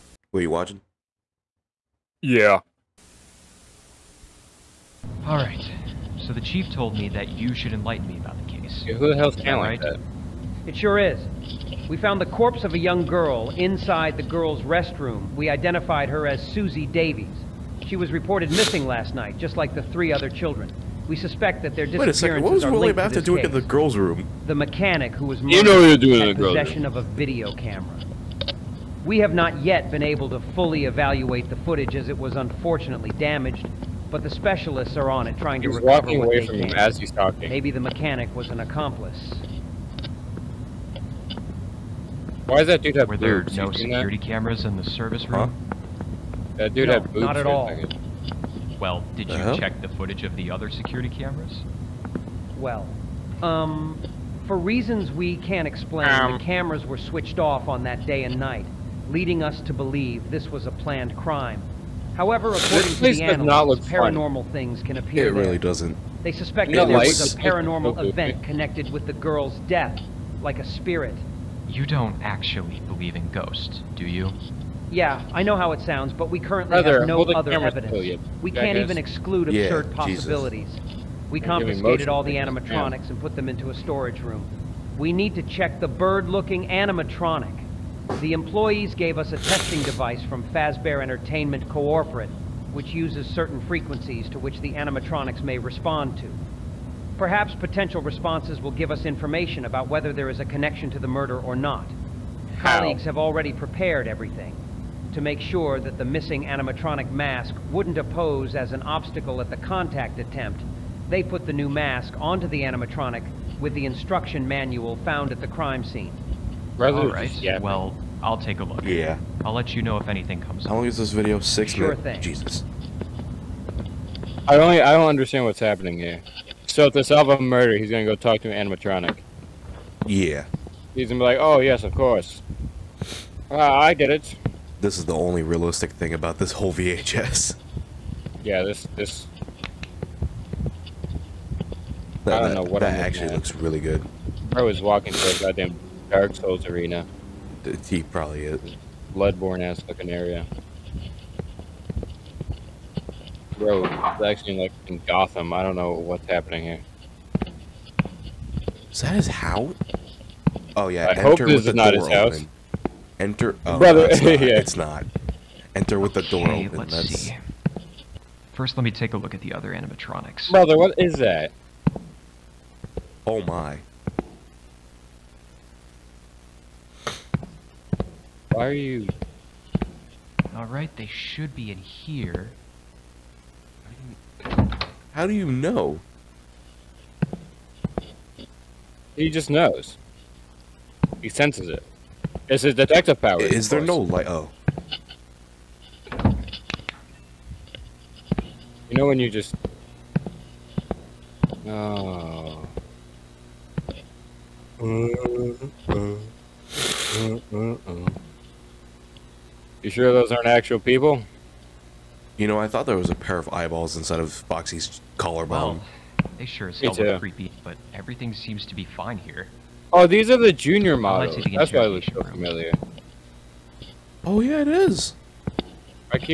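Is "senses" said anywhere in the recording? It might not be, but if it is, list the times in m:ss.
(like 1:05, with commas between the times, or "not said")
3:11.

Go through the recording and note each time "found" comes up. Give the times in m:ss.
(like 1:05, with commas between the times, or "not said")
0:11, 1:54.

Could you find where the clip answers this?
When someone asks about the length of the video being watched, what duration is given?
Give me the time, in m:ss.
2:01.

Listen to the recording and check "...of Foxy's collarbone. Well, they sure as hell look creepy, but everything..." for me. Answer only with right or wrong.
right.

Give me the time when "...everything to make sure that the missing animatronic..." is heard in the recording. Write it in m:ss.
1:44.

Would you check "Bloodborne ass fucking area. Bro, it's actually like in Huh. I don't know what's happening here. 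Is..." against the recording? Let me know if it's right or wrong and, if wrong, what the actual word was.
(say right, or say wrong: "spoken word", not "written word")
wrong: "Gotham", not "Huh".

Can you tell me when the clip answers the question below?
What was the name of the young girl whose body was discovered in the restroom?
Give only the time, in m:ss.
0:16.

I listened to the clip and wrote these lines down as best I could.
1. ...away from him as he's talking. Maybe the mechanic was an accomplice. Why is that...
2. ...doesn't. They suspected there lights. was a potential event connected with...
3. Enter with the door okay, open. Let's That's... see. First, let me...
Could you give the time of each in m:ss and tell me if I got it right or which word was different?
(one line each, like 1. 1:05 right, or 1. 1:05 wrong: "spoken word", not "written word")
1. 0:36 right
2. 1:05 wrong: "paranormal", not "potential"
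3. 2:45 right.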